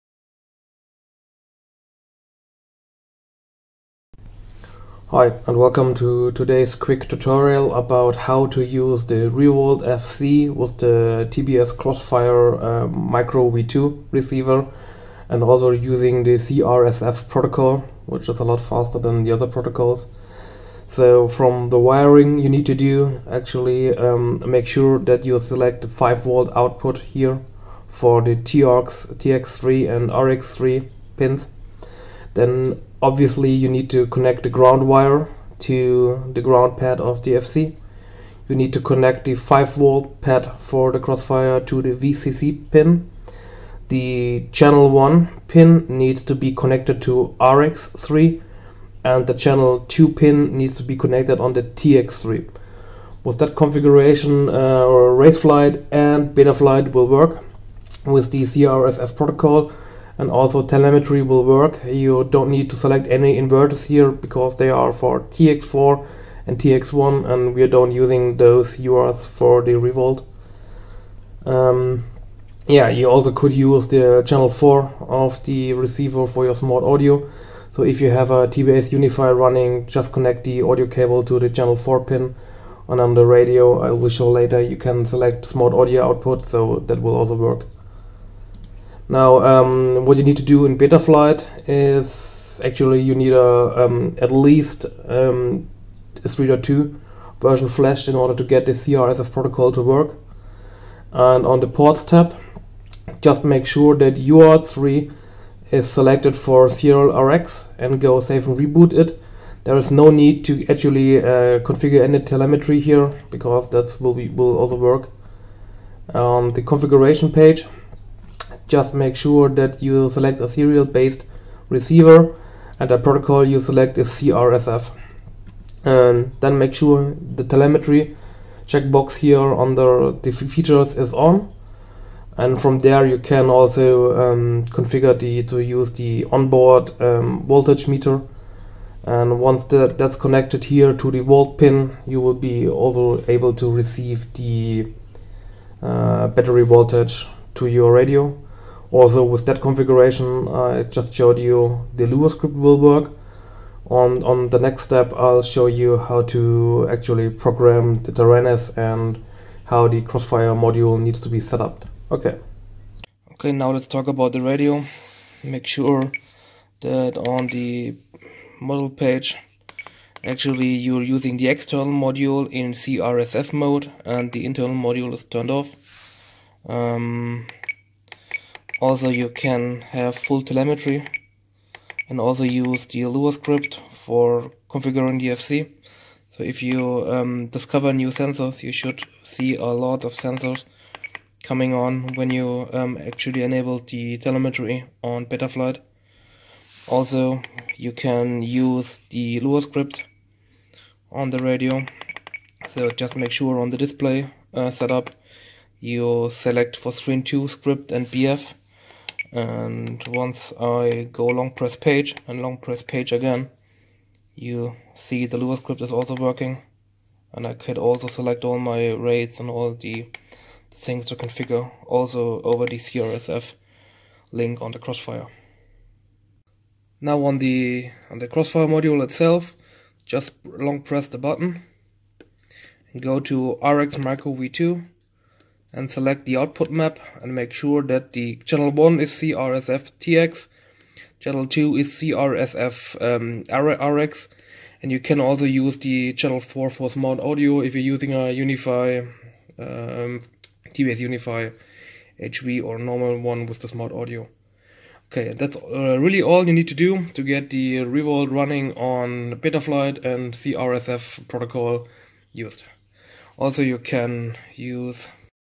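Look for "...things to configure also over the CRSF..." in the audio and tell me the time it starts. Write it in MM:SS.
03:40.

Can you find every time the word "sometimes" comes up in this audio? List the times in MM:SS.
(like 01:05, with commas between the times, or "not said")
not said.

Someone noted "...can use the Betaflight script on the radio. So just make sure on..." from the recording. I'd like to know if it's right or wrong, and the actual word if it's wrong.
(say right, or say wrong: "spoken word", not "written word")
wrong: "Lua", not "Betaflight".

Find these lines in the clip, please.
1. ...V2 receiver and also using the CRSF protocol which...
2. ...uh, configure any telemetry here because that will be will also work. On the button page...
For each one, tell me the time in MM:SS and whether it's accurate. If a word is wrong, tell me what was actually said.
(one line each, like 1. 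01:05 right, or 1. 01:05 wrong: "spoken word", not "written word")
1. 00:13 right
2. 01:51 wrong: "configuration", not "button".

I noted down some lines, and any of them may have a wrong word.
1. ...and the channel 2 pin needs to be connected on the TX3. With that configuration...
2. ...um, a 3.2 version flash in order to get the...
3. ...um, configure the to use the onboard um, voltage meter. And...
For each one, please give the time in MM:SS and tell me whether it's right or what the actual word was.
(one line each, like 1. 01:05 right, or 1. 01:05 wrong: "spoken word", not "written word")
1. 00:49 right
2. 01:35 right
3. 02:14 right.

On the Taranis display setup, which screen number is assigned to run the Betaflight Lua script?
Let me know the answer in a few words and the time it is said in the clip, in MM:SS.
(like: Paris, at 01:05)
2, at 03:26.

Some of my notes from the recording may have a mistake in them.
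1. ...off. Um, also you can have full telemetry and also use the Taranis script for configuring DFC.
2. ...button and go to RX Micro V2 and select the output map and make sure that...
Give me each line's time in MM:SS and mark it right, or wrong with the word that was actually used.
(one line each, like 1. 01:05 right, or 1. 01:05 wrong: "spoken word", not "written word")
1. 02:55 wrong: "Lua", not "Taranis"
2. 03:51 right.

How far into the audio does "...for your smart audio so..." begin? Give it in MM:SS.
01:16.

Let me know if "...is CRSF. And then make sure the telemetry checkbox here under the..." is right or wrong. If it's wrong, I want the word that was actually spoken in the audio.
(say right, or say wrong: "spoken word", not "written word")
right.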